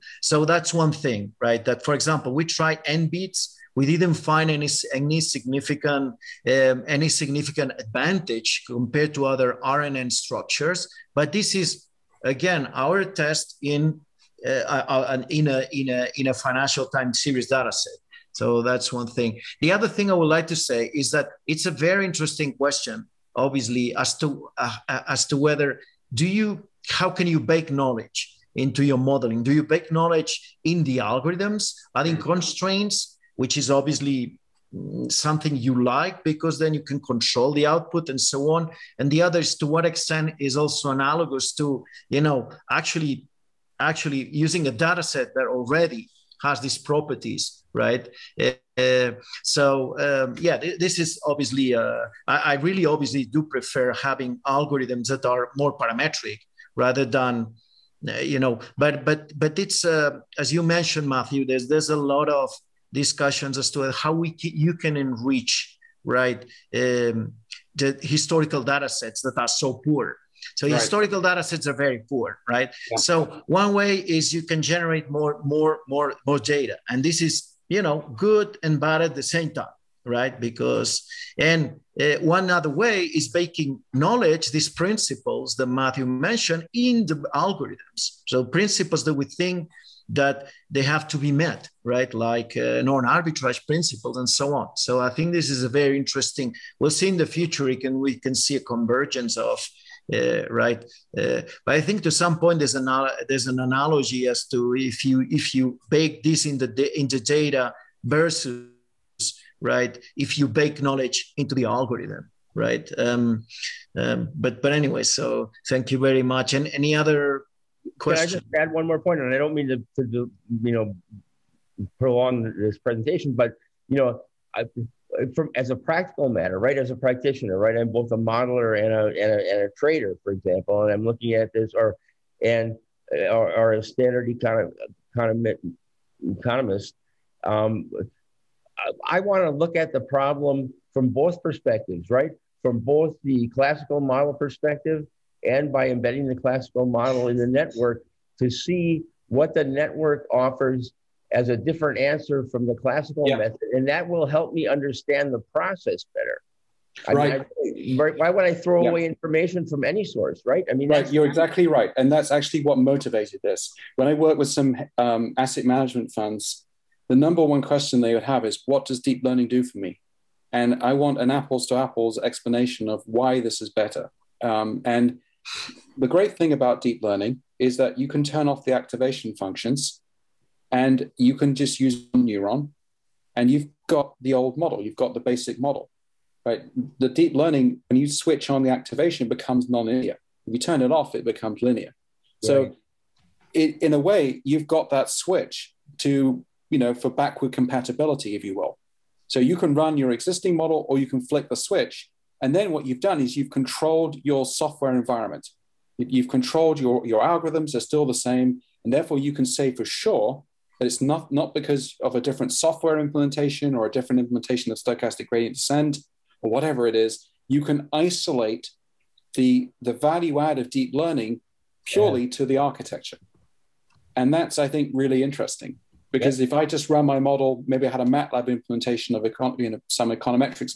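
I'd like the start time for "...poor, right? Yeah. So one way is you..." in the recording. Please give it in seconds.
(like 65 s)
72 s.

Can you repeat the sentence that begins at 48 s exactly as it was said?
Uh, uh so um, yeah, th- this is obviously.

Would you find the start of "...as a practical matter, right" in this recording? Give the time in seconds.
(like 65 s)
125 s.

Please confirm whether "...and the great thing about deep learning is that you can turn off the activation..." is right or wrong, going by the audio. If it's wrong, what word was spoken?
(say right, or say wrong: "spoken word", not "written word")
right.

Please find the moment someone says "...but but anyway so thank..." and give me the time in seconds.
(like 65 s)
114 s.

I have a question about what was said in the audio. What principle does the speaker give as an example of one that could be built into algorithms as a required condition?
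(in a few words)
Non-arbitrage principles.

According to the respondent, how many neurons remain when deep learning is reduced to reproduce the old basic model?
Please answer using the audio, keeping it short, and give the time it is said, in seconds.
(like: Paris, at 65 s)
1, at 182 s.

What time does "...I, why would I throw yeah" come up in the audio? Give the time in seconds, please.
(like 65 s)
158 s.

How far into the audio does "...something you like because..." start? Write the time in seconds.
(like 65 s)
35 s.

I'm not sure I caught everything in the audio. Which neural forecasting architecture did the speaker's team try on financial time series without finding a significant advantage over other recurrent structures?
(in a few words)
N-BEATS.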